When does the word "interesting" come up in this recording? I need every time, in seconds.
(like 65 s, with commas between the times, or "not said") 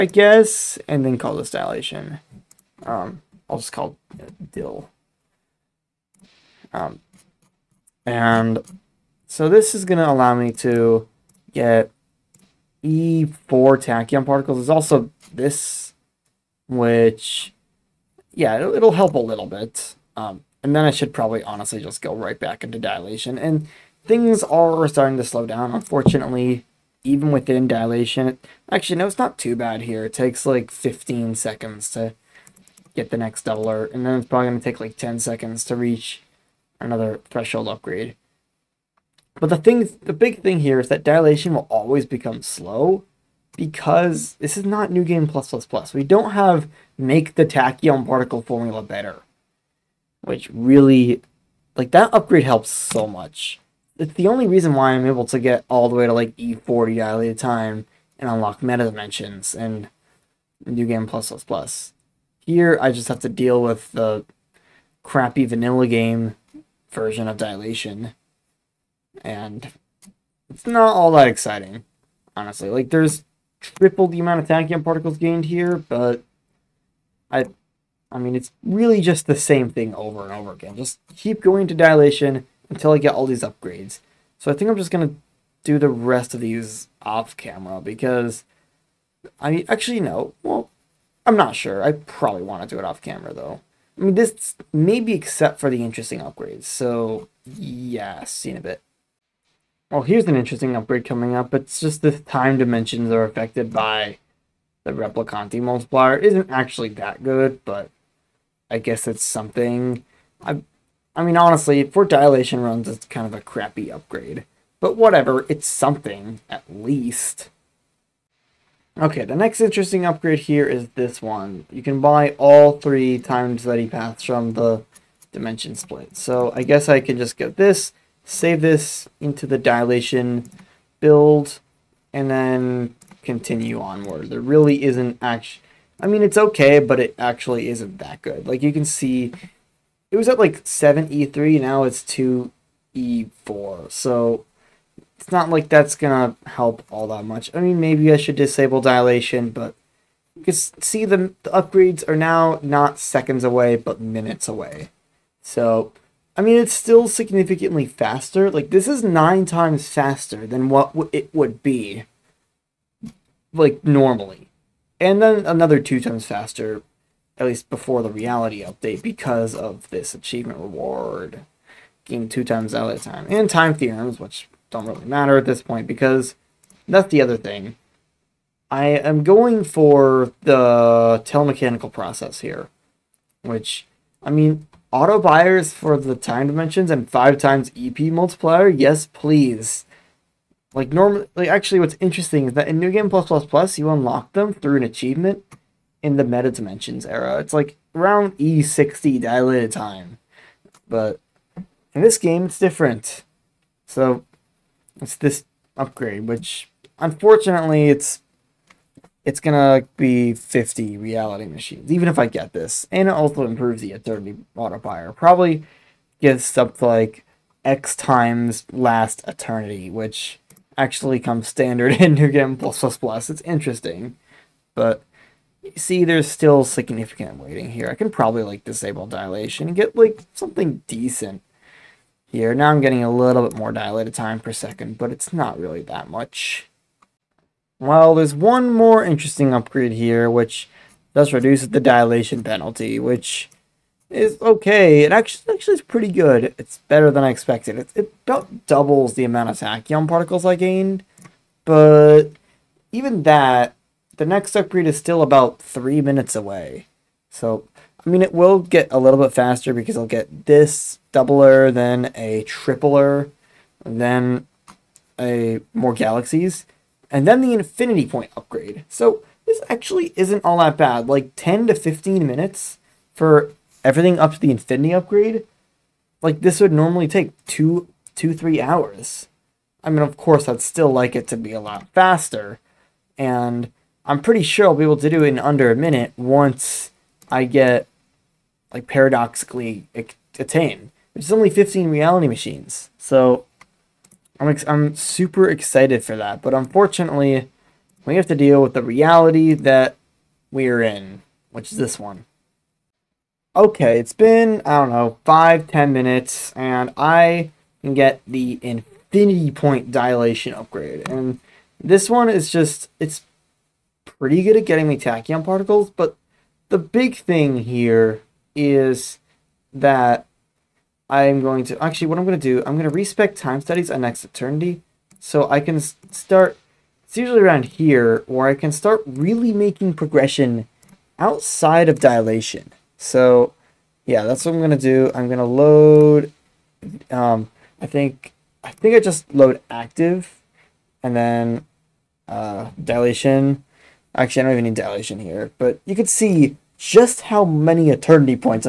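95 s, 100 s, 119 s, 192 s, 223 s, 239 s.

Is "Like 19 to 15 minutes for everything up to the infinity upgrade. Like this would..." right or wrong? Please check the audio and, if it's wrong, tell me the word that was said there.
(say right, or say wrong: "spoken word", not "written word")
wrong: "10", not "19".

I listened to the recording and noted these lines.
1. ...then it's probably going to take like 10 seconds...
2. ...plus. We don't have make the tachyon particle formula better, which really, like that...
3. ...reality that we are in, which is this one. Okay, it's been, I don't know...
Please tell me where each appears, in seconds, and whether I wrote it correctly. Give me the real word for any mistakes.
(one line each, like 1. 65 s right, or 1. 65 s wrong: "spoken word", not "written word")
1. 34 s right
2. 45 s right
3. 298 s right.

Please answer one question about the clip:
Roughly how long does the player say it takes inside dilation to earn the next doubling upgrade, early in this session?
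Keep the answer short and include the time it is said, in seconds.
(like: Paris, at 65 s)
15 seconds, at 30 s.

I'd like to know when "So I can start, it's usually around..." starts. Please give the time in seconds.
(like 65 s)
325 s.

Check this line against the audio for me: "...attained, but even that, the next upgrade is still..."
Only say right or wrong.
wrong.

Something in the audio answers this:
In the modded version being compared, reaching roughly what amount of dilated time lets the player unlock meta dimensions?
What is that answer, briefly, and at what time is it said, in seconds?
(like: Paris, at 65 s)
E40, at 56 s.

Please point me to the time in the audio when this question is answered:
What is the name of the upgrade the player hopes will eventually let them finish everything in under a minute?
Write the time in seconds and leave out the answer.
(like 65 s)
288 s.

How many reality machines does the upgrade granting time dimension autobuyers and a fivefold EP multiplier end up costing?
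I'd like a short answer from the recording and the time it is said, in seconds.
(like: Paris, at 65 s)
50, at 210 s.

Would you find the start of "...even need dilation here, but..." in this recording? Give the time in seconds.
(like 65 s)
344 s.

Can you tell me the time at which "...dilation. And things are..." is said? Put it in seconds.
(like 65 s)
22 s.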